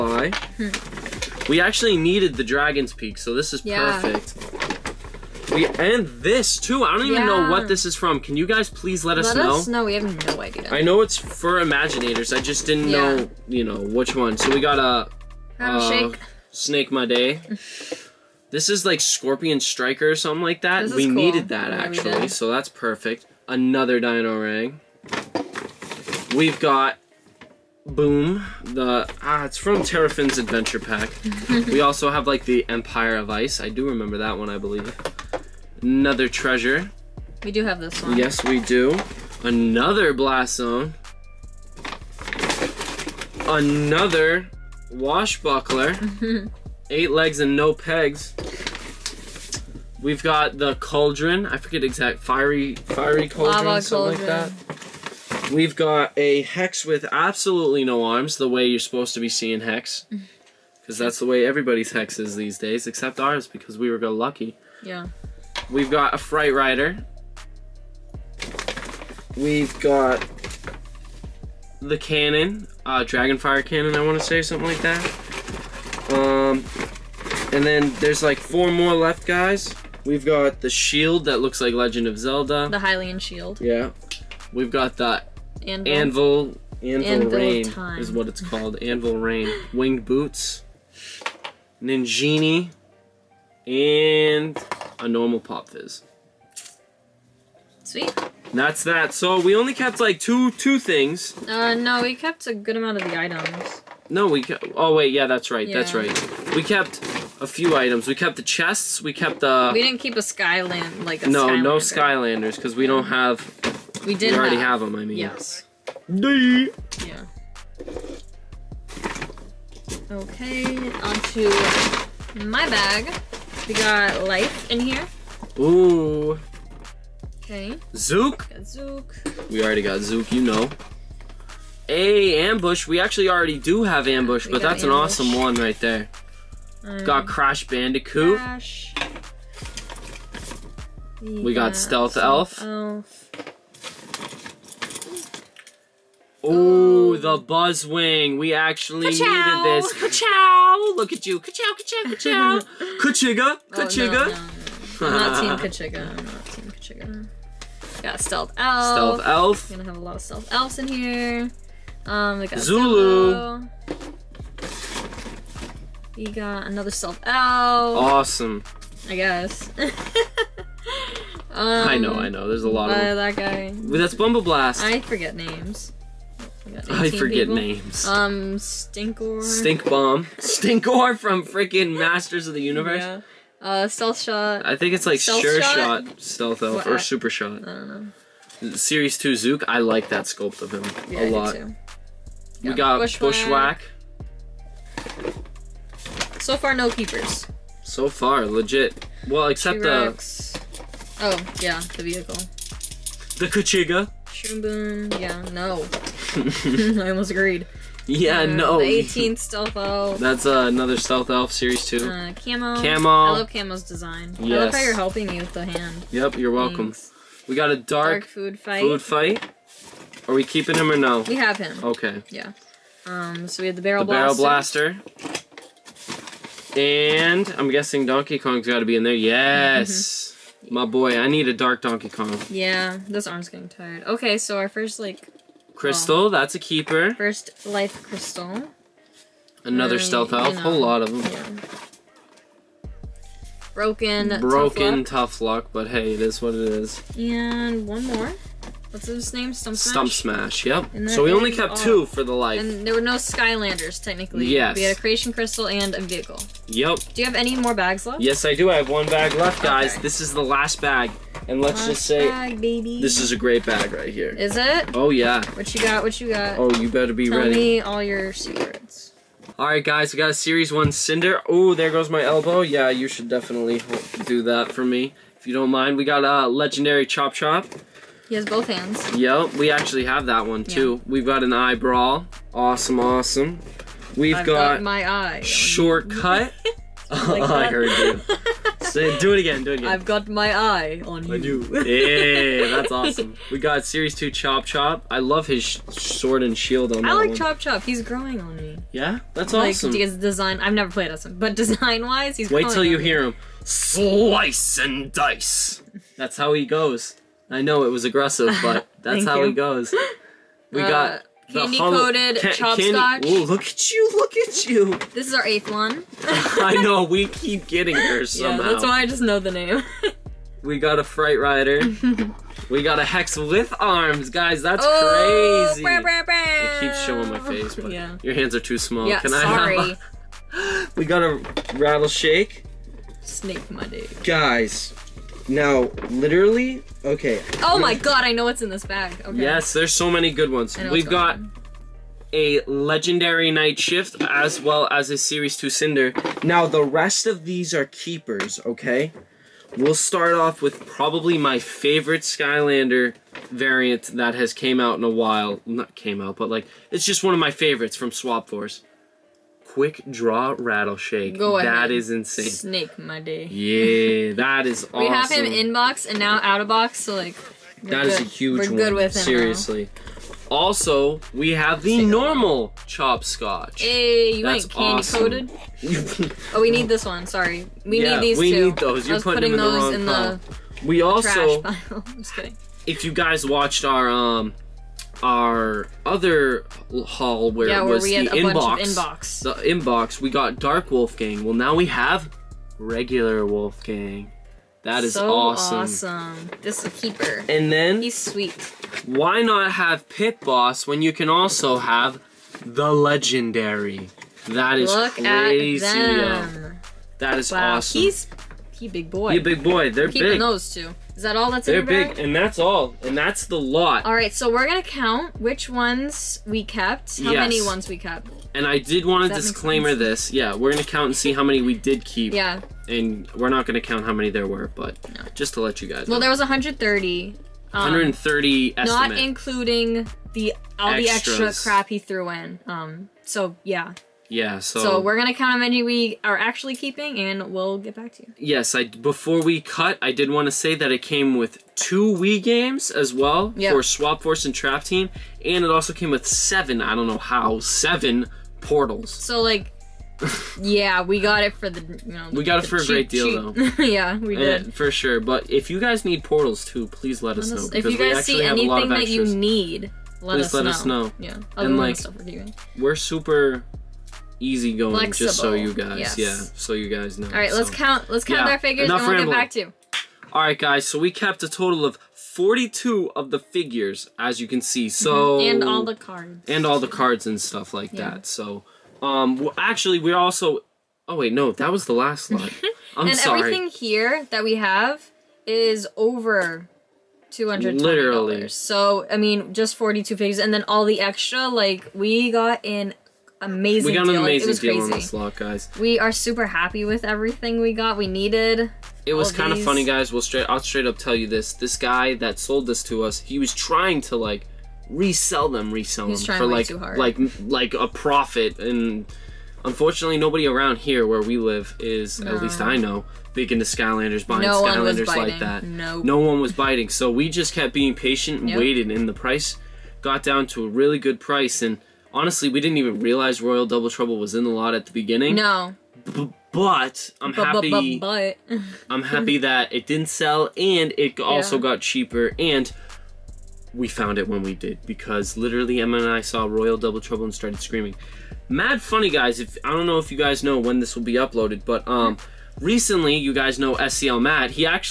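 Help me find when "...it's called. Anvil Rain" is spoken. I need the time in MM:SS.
01:28.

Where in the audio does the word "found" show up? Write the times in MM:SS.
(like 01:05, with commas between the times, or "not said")
08:53.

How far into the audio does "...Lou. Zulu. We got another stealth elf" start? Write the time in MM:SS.
02:42.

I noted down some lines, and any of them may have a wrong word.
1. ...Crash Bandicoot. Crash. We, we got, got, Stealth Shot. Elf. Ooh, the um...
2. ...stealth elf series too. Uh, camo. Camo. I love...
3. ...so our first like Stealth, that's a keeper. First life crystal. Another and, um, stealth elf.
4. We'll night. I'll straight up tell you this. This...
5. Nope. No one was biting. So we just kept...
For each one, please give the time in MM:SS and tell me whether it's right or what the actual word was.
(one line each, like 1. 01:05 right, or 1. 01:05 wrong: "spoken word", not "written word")
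1. 02:17 wrong: "Elf", not "Shot"
2. 03:30 right
3. 03:54 wrong: "Crystal", not "Stealth"
4. 08:20 wrong: "straight", not "night"
5. 08:35 right.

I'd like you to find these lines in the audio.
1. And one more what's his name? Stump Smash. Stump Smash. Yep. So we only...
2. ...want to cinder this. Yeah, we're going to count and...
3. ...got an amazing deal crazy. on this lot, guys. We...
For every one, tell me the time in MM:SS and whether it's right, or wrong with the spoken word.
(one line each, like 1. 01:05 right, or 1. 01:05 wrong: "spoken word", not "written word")
1. 04:07 right
2. 06:59 wrong: "disclaimer", not "cinder"
3. 08:13 right.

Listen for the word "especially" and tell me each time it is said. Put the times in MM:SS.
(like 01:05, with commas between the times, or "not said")
not said.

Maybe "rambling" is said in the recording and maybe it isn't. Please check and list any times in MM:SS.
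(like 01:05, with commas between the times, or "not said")
07:49.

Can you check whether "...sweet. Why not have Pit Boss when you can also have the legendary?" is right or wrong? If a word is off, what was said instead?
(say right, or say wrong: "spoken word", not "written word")
right.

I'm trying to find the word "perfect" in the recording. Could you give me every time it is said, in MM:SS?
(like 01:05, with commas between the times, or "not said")
00:04, 00:22.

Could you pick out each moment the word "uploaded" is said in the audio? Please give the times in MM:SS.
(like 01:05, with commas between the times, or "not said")
09:01.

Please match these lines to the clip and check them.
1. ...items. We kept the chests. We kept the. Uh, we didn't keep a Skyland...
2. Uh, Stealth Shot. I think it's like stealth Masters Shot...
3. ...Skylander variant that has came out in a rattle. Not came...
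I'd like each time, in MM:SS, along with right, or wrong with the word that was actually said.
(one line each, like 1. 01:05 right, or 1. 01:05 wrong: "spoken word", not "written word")
1. 01:47 right
2. 03:03 wrong: "Sure", not "Masters"
3. 05:52 wrong: "while", not "rattle".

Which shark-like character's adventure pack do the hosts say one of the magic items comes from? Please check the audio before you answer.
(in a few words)
Terrafin.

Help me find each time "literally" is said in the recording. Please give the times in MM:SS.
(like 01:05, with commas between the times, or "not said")
05:36, 08:07, 08:55.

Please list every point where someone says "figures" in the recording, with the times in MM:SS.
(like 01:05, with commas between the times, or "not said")
07:48, 07:53, 08:10.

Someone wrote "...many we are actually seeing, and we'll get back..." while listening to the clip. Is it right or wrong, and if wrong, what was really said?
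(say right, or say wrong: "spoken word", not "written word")
wrong: "keeping", not "seeing".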